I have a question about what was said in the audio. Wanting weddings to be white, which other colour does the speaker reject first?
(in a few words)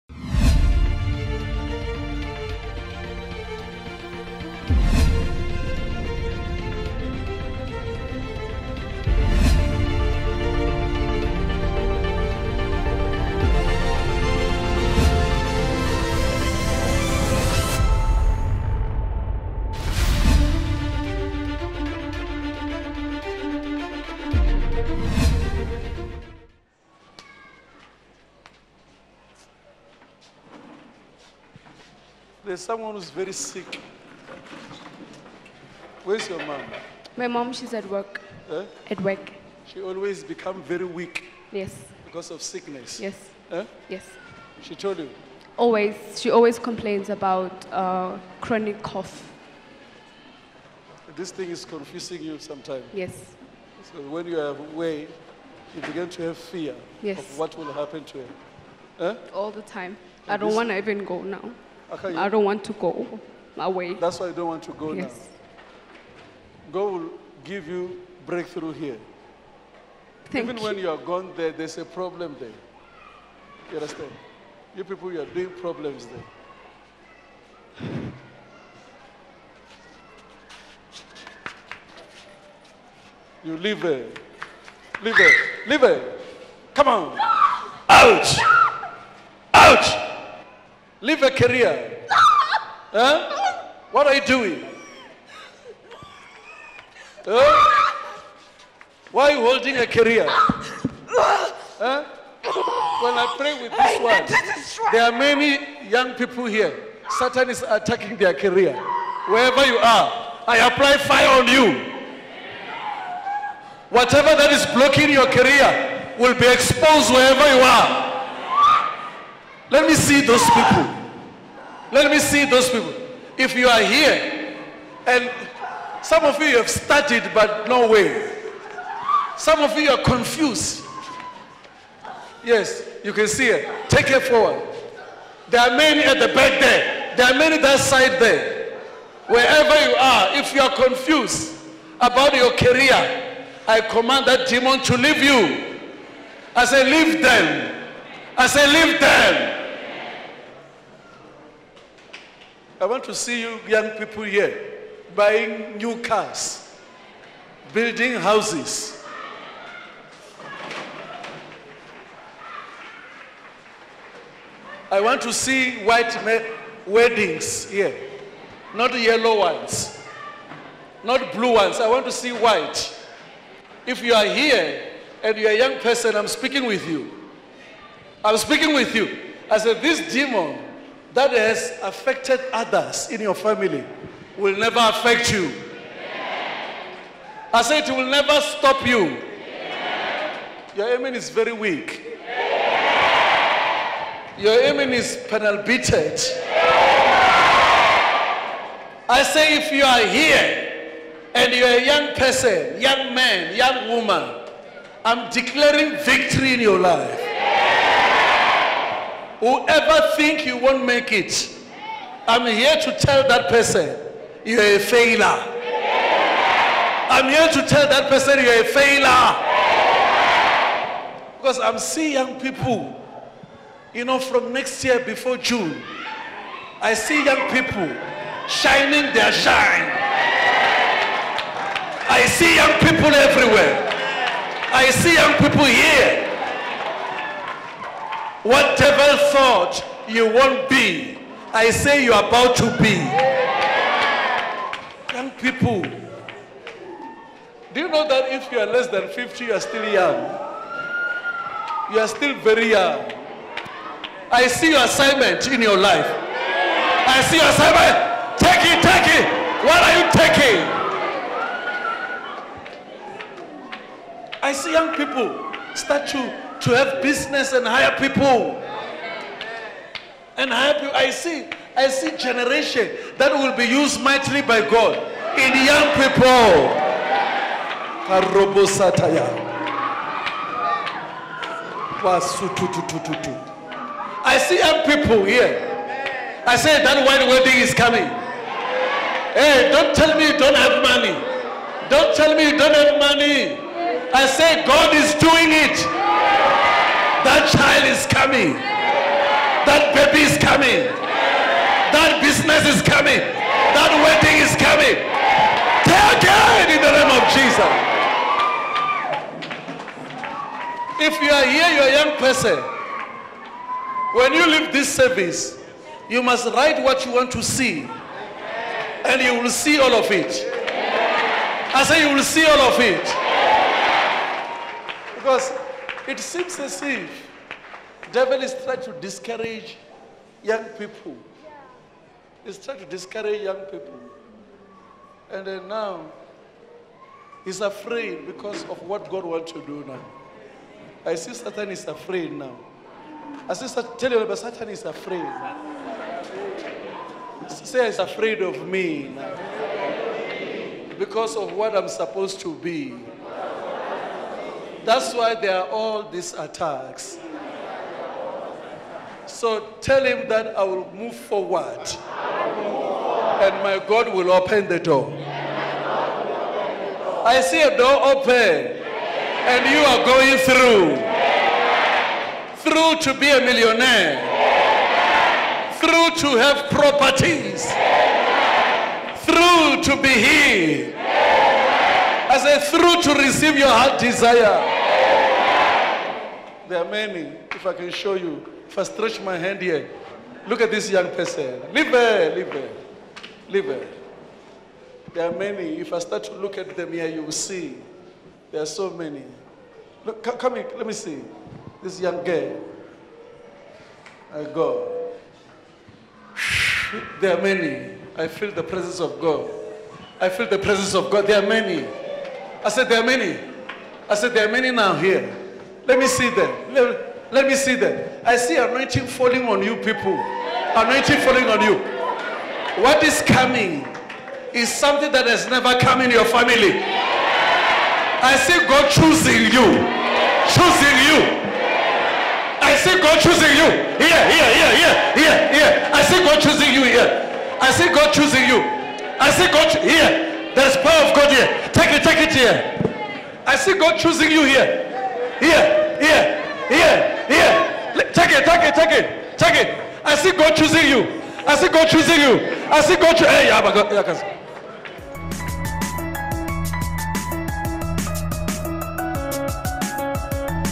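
yellow.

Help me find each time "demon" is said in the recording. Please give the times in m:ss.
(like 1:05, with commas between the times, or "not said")
2:24, 3:00.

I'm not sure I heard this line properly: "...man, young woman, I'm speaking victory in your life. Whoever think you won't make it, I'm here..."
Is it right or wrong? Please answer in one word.
wrong.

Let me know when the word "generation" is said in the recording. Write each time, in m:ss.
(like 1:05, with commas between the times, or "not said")
4:32.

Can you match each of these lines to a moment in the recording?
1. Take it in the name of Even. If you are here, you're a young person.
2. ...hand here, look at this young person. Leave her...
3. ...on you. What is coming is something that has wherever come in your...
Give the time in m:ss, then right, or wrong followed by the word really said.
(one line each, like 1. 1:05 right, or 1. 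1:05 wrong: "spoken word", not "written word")
1. 5:05 wrong: "Jesus", not "Even"
2. 6:29 right
3. 7:01 wrong: "never", not "wherever".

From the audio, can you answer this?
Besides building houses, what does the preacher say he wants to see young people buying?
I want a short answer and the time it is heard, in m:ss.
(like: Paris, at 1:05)
new cars, at 2:35.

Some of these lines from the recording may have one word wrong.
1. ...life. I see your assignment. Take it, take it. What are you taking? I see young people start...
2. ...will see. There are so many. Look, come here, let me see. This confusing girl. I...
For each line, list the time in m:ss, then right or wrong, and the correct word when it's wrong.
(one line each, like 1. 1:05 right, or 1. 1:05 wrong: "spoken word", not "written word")
1. 4:15 right
2. 6:37 wrong: "young", not "confusing".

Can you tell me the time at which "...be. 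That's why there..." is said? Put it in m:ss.
5:52.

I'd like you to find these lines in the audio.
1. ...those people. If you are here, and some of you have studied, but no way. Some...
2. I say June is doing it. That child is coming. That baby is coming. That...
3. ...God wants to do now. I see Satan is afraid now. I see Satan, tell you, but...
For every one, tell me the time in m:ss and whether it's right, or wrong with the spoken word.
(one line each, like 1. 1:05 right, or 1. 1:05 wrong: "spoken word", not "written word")
1. 2:02 right
2. 4:54 wrong: "God", not "June"
3. 5:39 right.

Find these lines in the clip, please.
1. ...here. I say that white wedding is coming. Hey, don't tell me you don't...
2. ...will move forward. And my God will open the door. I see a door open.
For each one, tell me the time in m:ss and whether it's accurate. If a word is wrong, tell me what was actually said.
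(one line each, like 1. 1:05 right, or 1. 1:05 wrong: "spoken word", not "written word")
1. 4:45 right
2. 6:00 right.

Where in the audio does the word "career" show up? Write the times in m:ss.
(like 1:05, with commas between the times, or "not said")
1:31, 1:39, 1:48, 1:55, 2:22.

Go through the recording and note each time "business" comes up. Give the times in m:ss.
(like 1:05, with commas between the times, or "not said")
4:27, 5:02.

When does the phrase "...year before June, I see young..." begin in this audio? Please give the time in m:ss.
3:44.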